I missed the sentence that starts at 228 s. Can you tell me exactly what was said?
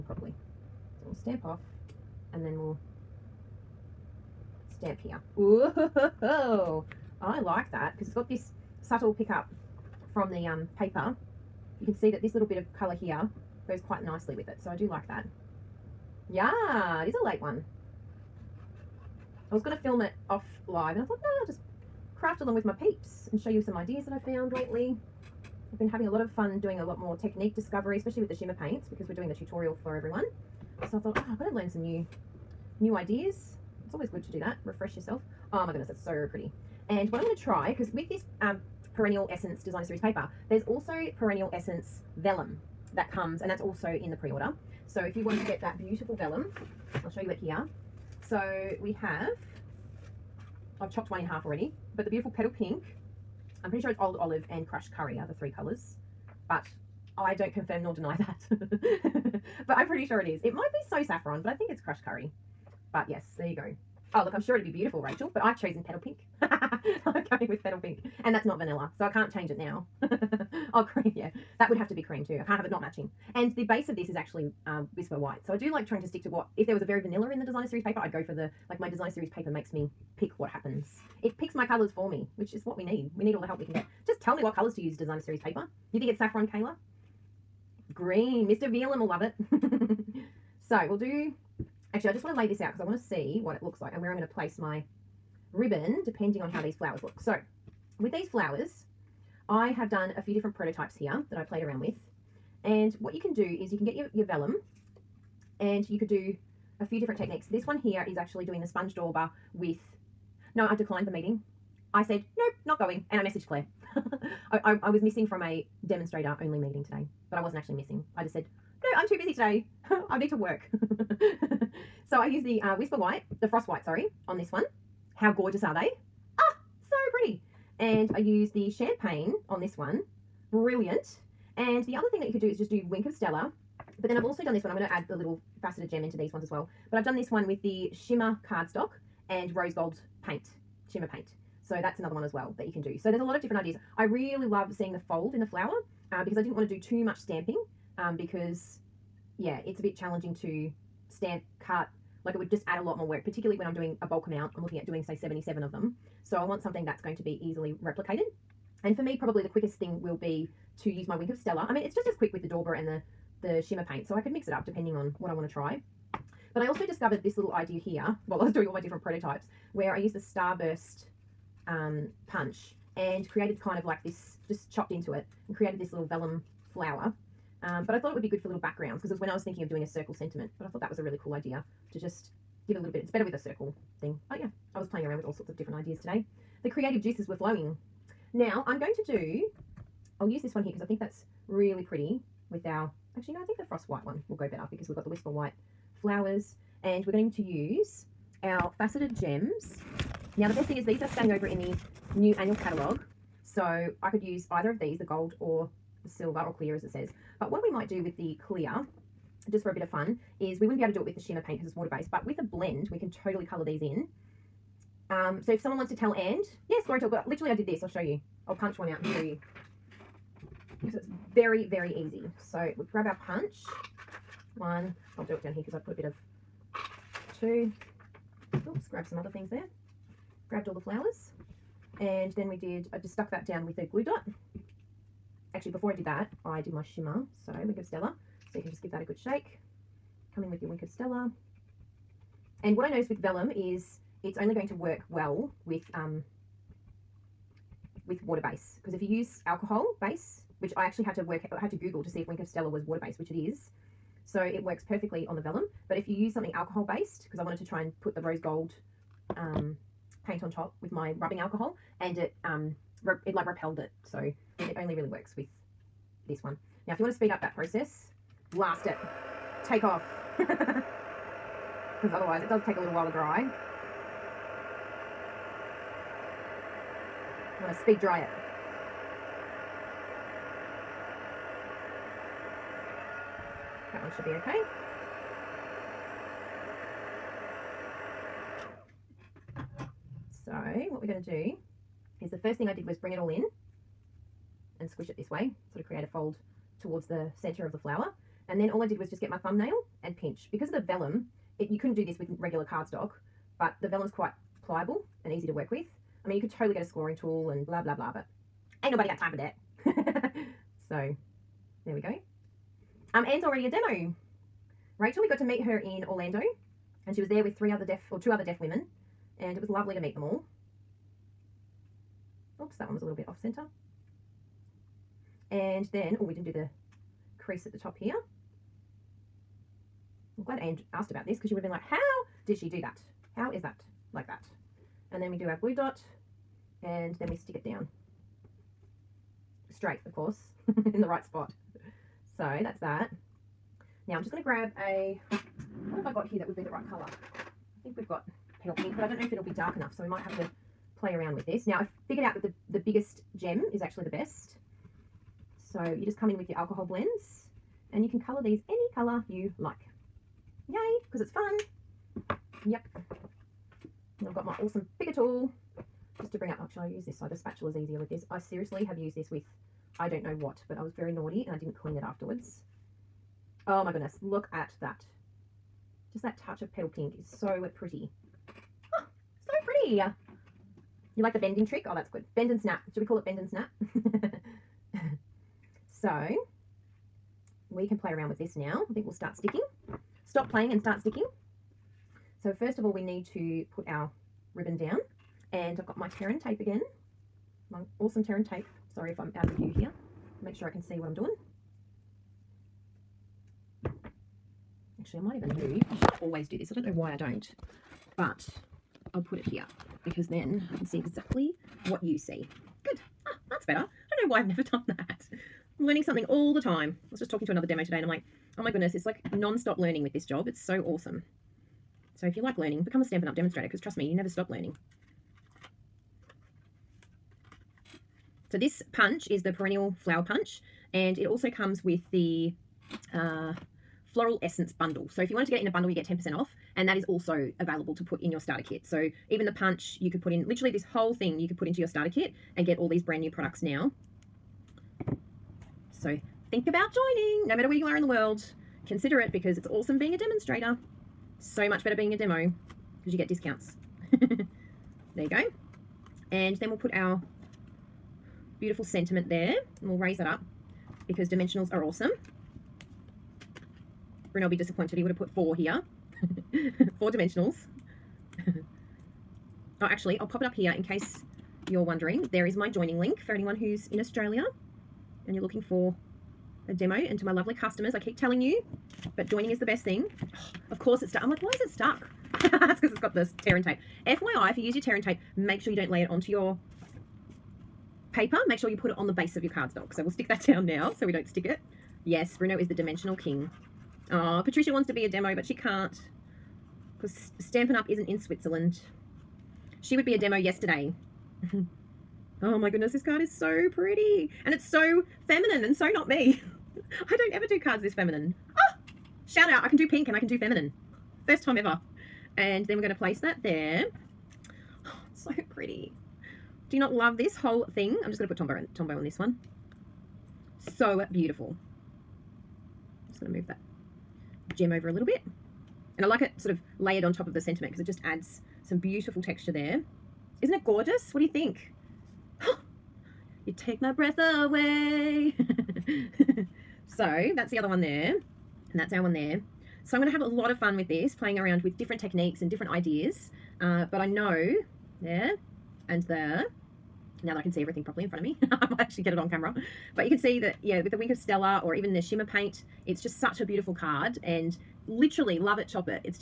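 Oops, grab some other things there.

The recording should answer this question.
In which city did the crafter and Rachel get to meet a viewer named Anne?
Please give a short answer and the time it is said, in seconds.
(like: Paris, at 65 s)
Orlando, at 316 s.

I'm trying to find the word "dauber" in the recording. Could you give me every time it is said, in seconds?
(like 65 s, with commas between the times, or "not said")
108 s, 162 s.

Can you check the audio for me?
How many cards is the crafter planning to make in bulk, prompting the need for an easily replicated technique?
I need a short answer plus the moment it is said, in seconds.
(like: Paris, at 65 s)
77, at 155 s.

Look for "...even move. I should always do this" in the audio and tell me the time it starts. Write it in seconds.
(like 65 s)
405 s.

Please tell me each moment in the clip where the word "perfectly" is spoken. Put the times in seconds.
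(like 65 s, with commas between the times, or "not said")
254 s.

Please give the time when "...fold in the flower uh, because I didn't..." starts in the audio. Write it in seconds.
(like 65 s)
145 s.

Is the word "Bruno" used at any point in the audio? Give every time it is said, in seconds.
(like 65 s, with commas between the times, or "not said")
464 s, 492 s.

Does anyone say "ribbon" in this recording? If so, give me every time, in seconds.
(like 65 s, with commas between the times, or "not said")
95 s, 394 s.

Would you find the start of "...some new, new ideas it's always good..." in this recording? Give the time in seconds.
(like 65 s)
31 s.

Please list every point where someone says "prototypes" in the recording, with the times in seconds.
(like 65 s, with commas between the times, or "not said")
100 s, 169 s.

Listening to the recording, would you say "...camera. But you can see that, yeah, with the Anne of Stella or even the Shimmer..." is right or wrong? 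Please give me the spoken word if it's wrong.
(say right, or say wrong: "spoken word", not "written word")
wrong: "Wink", not "Anne".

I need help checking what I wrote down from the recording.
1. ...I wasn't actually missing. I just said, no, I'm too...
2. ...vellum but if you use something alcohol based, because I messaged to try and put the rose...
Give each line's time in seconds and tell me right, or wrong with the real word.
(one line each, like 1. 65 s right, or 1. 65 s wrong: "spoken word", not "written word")
1. 117 s right
2. 255 s wrong: "wanted", not "messaged".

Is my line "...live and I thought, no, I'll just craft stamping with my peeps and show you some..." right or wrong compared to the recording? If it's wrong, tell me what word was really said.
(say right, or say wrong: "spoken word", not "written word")
wrong: "along", not "stamping".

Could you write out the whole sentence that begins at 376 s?
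Just that touch of petal pink is so pretty.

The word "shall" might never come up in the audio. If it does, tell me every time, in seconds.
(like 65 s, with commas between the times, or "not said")
366 s.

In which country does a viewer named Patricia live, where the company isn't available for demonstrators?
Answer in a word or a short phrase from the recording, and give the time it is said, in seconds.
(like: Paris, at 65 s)
Switzerland, at 498 s.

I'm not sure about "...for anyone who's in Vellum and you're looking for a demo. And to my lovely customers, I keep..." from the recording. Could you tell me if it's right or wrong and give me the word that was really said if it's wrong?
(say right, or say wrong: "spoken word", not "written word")
wrong: "Australia", not "Vellum".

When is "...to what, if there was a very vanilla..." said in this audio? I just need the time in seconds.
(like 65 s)
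76 s.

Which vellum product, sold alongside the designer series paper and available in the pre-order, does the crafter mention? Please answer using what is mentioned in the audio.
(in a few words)
Perennial Essence Vellum.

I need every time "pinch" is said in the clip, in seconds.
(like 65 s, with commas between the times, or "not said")
300 s.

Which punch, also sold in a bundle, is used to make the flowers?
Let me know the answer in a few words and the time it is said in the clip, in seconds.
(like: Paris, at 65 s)
perennial flower punch, at 429 s.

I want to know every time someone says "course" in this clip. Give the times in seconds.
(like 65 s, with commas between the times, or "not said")
340 s, 480 s.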